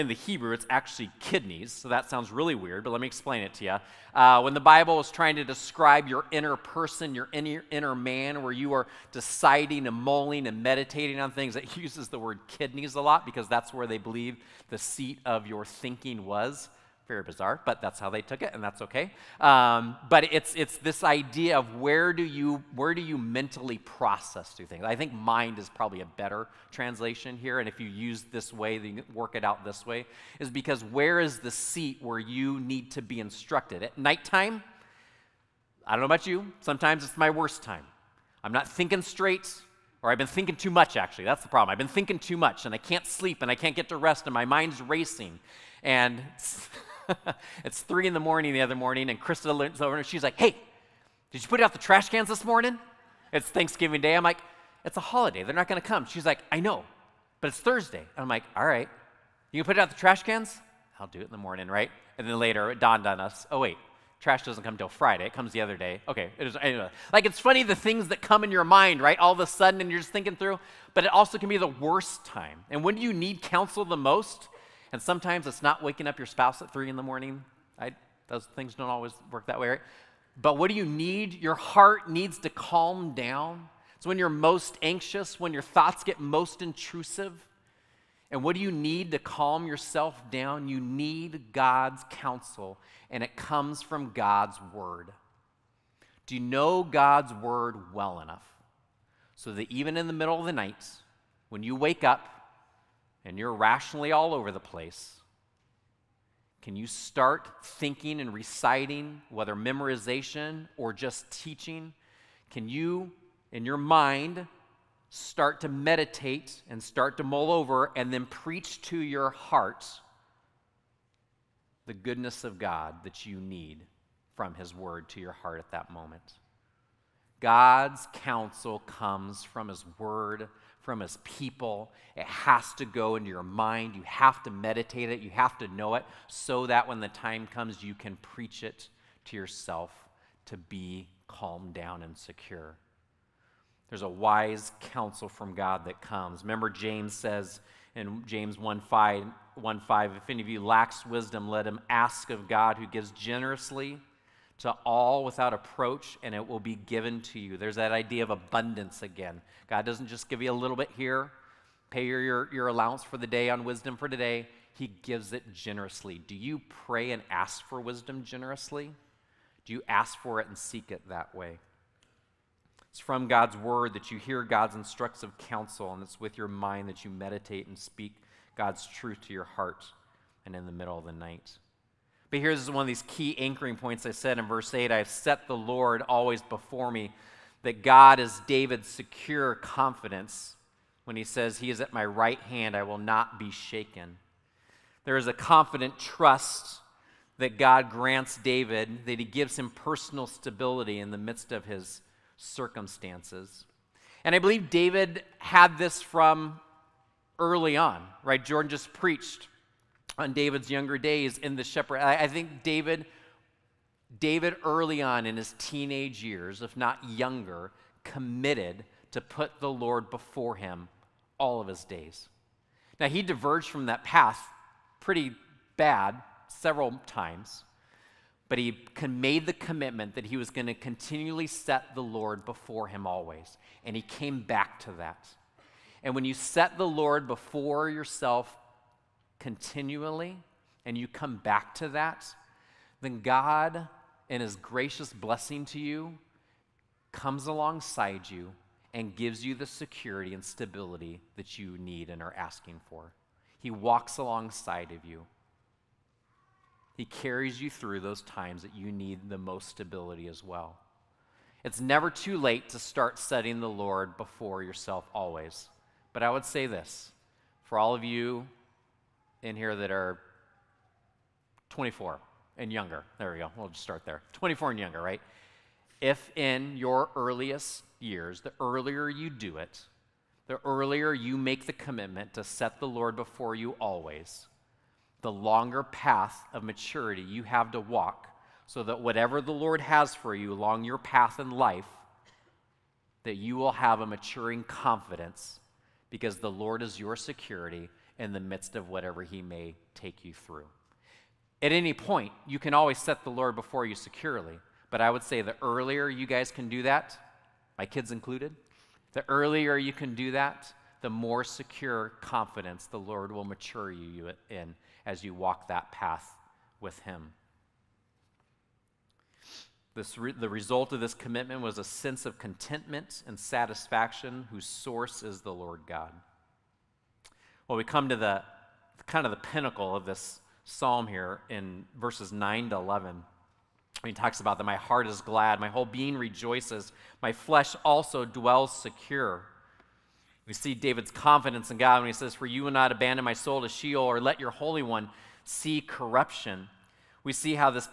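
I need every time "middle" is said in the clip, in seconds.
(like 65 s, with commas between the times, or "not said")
100 s, 180 s.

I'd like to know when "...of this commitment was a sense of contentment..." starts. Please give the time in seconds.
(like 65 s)
320 s.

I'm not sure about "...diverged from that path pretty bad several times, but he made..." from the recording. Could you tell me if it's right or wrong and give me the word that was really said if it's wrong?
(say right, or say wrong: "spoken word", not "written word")
right.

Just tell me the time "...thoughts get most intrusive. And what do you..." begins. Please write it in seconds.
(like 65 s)
85 s.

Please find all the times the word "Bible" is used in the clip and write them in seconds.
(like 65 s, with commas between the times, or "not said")
4 s.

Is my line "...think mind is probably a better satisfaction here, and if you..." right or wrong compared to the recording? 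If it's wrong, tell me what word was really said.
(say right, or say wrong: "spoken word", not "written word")
wrong: "translation", not "satisfaction".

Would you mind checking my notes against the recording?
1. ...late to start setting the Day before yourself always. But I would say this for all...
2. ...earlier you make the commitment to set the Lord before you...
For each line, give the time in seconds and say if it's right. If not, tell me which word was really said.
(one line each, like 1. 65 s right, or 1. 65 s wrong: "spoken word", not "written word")
1. 262 s wrong: "Lord", not "Day"
2. 280 s right.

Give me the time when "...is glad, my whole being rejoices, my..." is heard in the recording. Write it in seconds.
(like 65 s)
335 s.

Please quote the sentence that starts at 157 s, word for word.
There's that idea of abundance again.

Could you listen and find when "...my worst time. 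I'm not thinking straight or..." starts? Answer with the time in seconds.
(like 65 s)
37 s.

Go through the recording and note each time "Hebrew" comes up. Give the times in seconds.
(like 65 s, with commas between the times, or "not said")
0 s.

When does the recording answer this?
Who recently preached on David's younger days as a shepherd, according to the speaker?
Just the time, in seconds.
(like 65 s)
208 s.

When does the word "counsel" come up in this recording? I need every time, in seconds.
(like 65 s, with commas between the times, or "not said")
73 s, 92 s, 128 s, 144 s, 175 s.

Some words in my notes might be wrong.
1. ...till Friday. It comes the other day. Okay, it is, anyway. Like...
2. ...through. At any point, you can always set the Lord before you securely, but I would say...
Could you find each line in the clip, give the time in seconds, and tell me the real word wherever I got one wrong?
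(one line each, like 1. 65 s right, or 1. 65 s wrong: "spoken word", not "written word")
1. 64 s right
2. 300 s right.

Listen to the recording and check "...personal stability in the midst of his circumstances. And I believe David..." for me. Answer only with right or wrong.
right.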